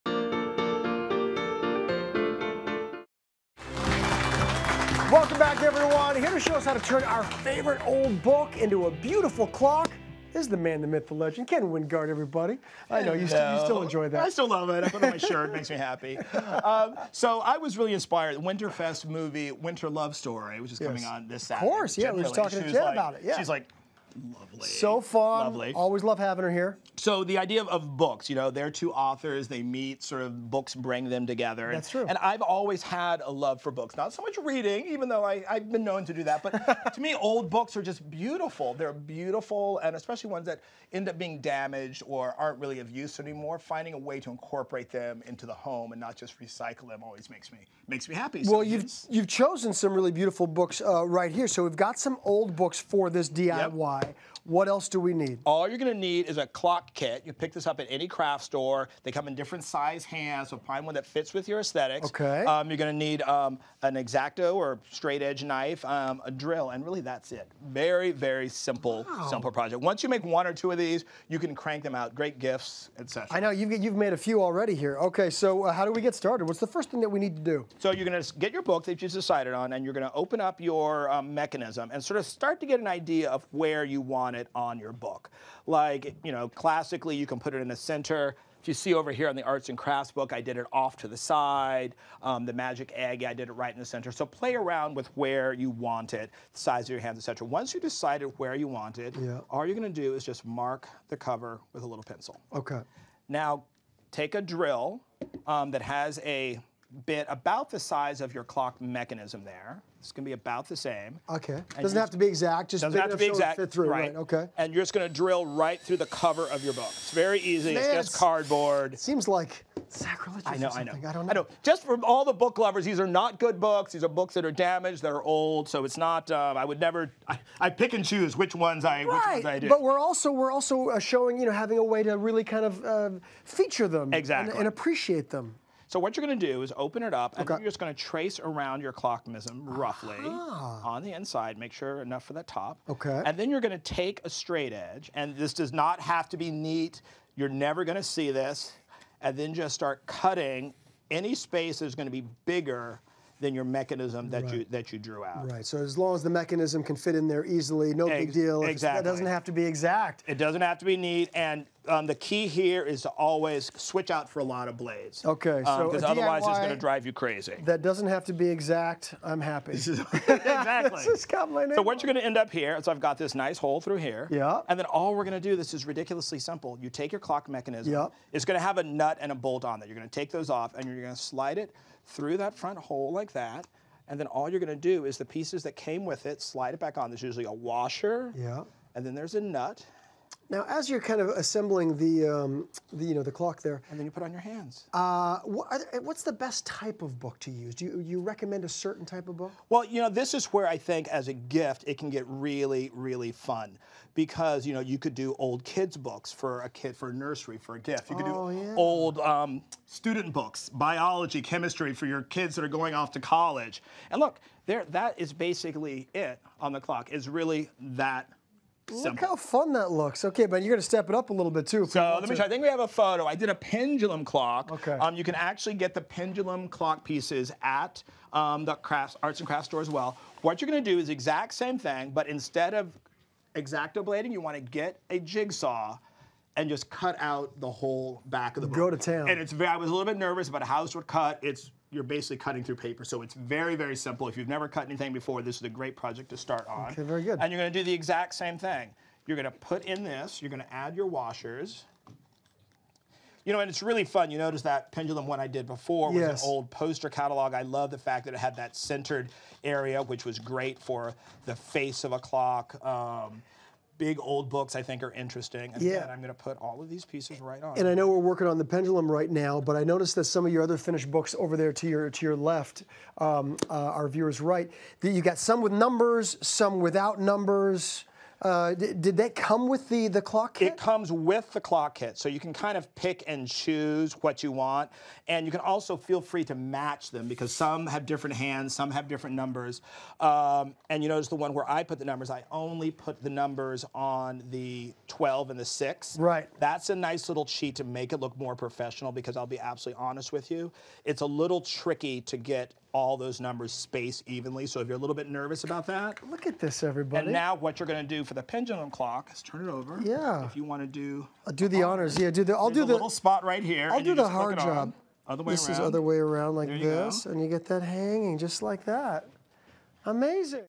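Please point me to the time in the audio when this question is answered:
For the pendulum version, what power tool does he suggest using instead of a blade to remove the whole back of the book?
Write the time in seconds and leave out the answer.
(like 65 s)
235 s.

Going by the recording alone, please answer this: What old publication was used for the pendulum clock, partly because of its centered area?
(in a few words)
poster catalog.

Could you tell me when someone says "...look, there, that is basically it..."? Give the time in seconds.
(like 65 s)
214 s.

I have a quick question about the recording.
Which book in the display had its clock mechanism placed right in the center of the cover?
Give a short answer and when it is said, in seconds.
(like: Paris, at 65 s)
the magic egg, at 92 s.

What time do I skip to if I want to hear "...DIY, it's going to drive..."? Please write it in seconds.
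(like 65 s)
166 s.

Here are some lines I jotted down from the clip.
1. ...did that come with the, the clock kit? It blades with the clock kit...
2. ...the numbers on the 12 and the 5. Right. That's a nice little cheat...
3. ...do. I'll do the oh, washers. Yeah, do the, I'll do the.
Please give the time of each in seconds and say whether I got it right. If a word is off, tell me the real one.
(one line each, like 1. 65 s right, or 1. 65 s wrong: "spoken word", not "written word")
1. 278 s wrong: "comes", not "blades"
2. 293 s wrong: "6", not "5"
3. 310 s wrong: "honors", not "washers".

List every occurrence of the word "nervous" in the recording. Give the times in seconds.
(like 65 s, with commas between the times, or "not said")
240 s, 305 s.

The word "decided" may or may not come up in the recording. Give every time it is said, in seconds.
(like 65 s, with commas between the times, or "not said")
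79 s, 97 s.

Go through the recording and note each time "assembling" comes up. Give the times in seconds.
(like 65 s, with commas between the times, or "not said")
191 s.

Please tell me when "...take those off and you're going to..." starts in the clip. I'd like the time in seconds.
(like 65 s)
180 s.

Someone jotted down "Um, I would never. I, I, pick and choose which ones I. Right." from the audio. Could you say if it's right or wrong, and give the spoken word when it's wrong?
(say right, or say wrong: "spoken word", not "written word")
right.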